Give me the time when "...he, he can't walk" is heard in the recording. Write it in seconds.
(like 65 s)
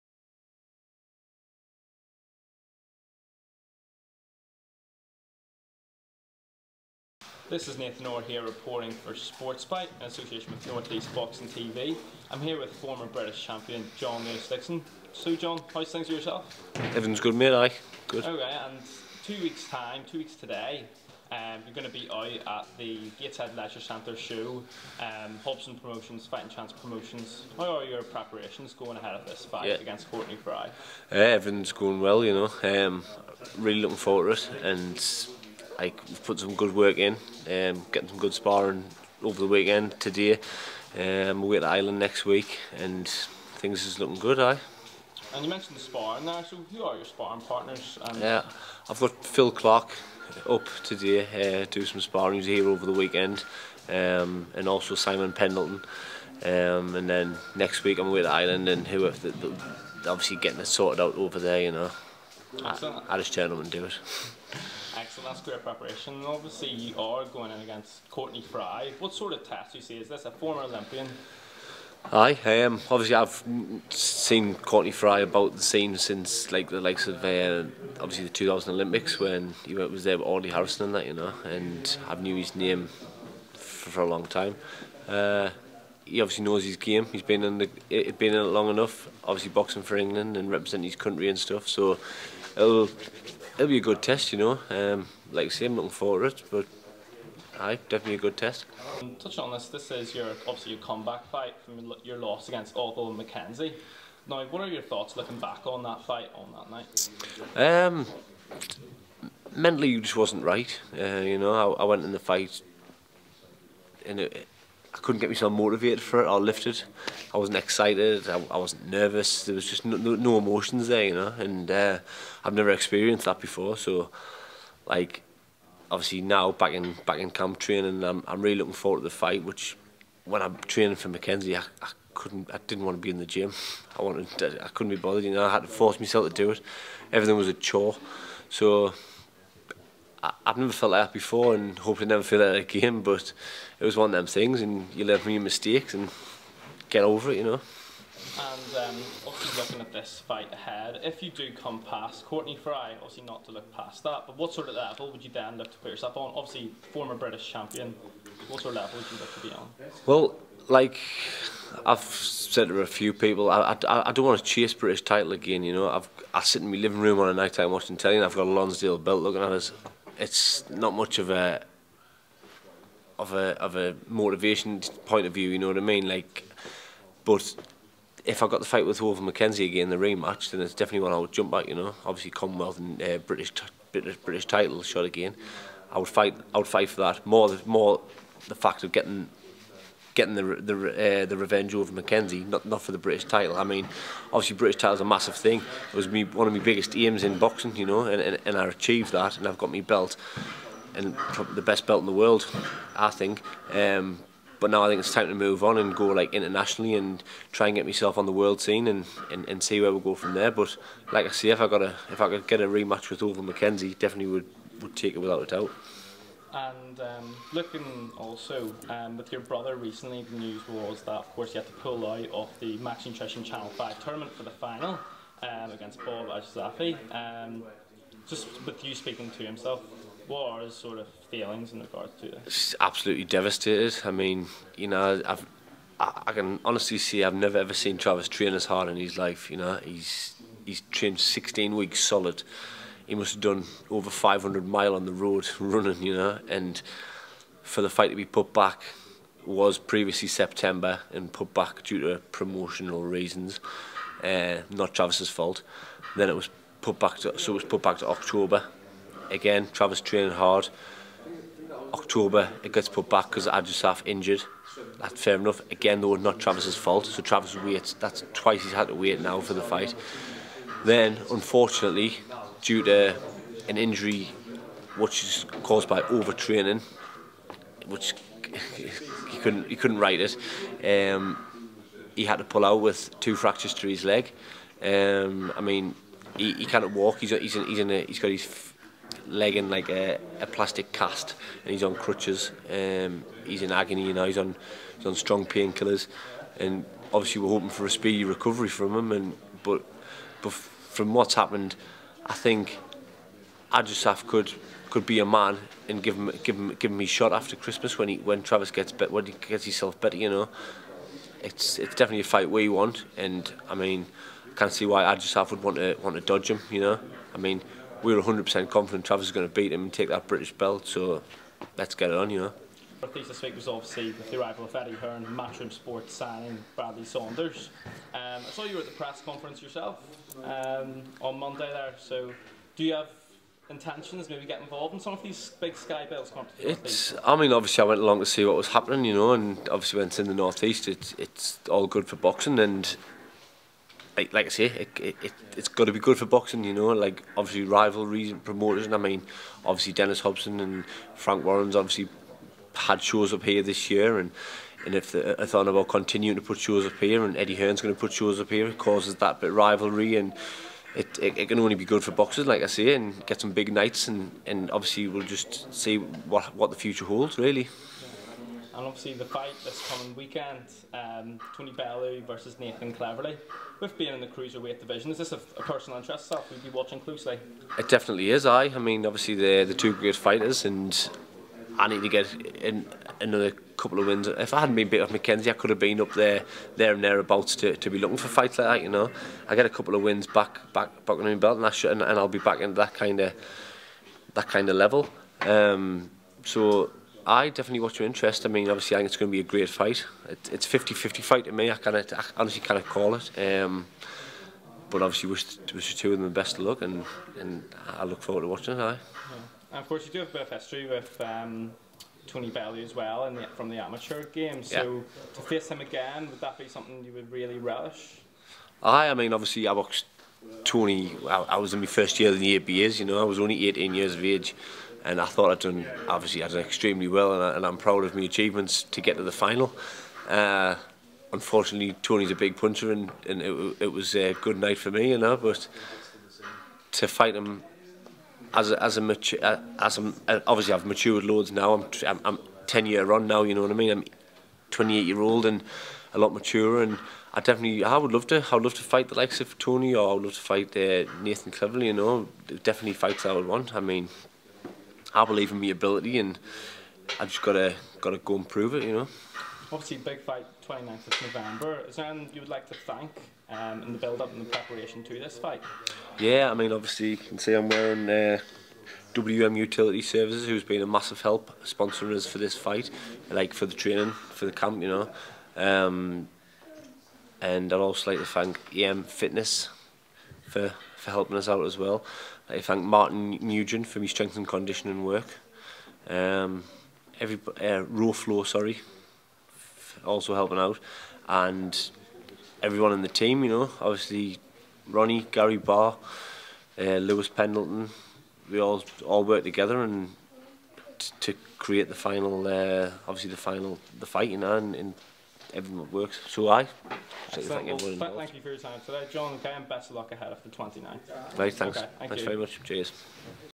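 286 s.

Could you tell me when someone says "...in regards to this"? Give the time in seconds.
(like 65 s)
231 s.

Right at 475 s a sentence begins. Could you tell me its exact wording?
Um, and I'd also like to thank EM Fitness for, for helping us out as well.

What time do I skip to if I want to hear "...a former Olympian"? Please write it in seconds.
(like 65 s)
70 s.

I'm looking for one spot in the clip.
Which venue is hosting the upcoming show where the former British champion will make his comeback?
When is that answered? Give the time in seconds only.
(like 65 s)
23 s.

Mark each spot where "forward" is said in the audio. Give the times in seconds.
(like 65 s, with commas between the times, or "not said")
33 s, 95 s, 128 s, 408 s.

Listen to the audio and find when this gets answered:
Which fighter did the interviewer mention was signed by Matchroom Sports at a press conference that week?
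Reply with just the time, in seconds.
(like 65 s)
326 s.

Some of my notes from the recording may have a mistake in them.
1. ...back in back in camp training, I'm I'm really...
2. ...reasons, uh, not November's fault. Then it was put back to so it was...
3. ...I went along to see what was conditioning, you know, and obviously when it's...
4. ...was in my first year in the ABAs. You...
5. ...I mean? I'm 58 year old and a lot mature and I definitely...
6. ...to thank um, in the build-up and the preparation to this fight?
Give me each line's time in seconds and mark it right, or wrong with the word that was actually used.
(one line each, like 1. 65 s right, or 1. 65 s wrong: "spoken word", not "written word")
1. 126 s right
2. 253 s wrong: "Travis", not "November"
3. 337 s wrong: "happening", not "conditioning"
4. 421 s right
5. 443 s wrong: "28", not "58"
6. 462 s right.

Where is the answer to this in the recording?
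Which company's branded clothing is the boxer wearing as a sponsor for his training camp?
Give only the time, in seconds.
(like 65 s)
469 s.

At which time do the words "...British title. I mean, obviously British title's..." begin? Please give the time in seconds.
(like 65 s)
192 s.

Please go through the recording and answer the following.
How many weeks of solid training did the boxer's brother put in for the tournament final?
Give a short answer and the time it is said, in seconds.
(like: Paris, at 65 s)
16, at 241 s.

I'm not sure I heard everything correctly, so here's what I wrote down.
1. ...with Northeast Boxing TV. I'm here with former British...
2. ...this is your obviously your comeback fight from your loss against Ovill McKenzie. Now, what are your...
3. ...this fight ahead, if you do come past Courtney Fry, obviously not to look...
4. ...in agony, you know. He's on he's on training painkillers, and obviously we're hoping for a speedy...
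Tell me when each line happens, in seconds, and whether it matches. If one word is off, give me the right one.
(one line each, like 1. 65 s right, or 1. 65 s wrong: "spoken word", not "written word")
1. 10 s right
2. 99 s right
3. 149 s right
4. 293 s wrong: "strong", not "training".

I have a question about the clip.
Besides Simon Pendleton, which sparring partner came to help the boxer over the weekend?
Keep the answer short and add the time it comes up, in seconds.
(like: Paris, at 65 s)
Phil Clark, at 49 s.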